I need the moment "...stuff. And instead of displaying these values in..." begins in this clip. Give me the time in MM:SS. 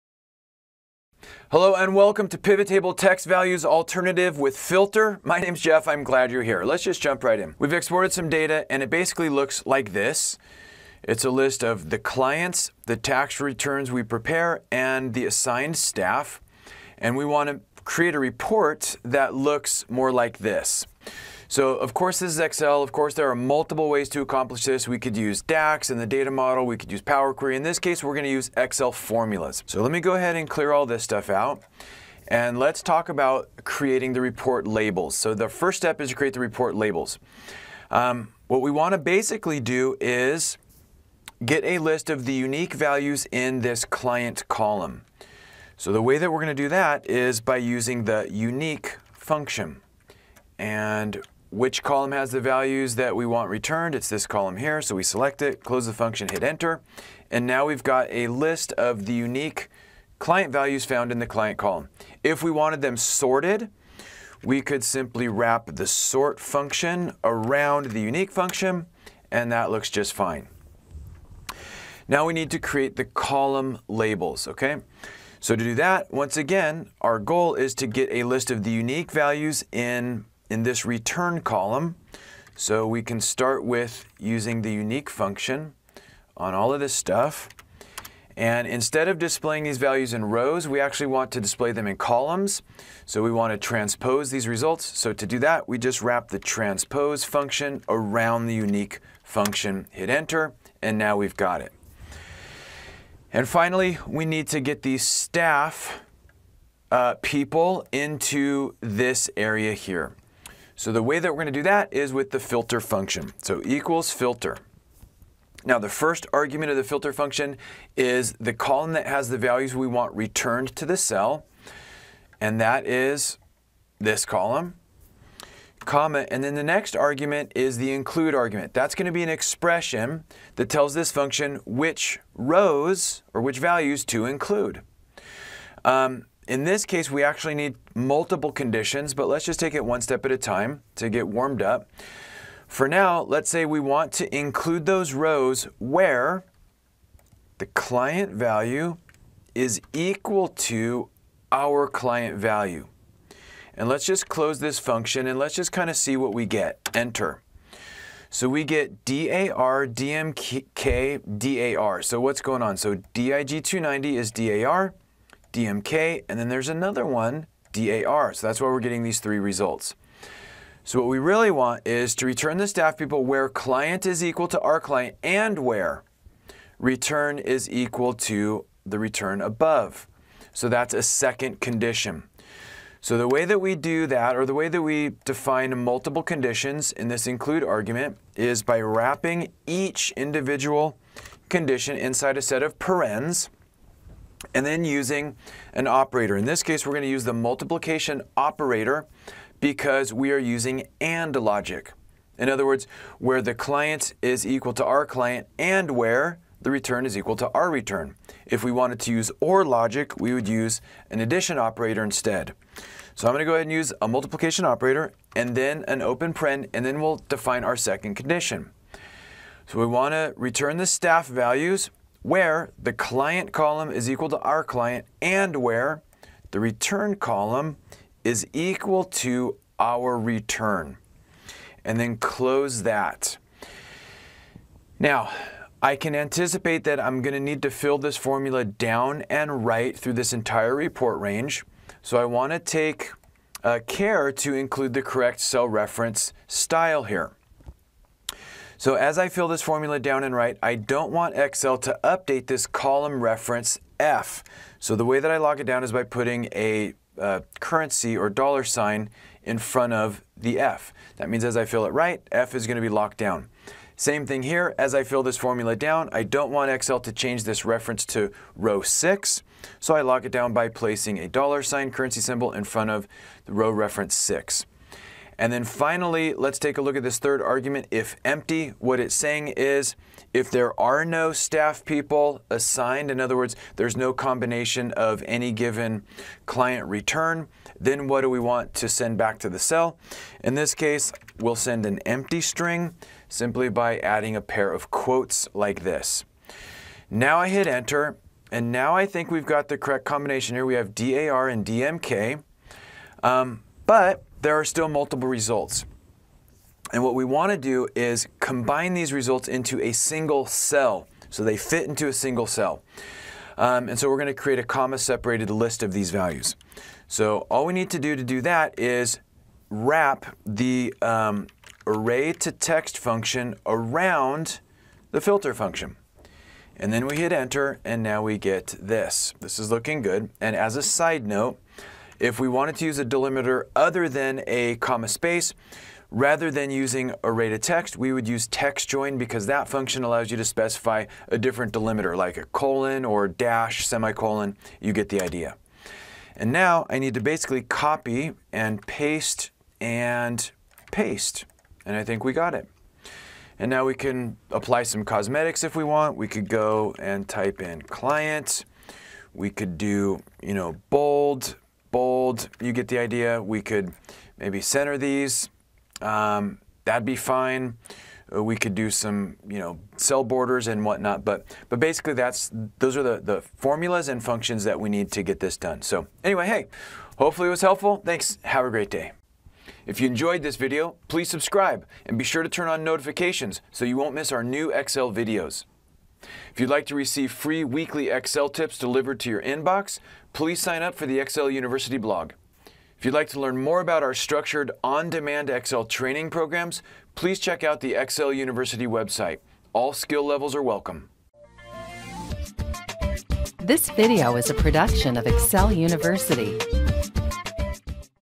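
01:26.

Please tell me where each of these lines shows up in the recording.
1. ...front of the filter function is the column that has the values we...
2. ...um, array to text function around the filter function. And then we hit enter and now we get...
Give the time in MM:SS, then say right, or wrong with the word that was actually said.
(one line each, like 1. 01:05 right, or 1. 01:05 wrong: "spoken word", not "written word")
1. 01:56 wrong: "argument", not "front"
2. 05:21 right.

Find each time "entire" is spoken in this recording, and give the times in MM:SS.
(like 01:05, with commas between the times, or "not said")
04:00.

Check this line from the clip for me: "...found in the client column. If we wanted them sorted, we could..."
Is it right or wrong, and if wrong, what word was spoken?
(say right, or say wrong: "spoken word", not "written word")
right.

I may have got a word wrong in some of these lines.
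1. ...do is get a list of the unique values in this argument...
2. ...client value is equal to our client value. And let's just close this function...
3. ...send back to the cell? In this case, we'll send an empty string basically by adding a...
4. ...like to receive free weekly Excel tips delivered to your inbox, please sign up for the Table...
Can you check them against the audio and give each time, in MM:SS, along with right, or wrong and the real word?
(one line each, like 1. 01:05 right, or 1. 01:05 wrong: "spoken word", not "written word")
1. 00:39 wrong: "client", not "argument"
2. 02:27 right
3. 04:48 wrong: "simply", not "basically"
4. 06:26 wrong: "Excel", not "Table".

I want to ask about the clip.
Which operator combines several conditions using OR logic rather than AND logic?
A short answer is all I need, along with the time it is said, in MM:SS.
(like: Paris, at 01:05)
addition operator, at 03:31.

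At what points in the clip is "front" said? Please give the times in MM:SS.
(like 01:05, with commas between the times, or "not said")
04:19, 04:32.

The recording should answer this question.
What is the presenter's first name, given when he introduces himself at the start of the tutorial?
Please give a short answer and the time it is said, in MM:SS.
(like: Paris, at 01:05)
Jeff, at 00:05.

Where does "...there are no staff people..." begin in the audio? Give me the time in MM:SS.
04:40.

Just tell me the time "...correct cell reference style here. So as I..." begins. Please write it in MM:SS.
04:05.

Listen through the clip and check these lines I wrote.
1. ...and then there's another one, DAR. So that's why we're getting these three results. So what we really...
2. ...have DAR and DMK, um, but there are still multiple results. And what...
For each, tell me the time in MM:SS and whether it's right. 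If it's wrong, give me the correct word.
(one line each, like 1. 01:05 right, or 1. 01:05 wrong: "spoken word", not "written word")
1. 02:46 right
2. 05:00 right.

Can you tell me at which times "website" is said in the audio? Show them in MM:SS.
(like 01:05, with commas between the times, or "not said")
06:38.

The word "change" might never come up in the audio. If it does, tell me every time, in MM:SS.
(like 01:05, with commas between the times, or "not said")
04:27.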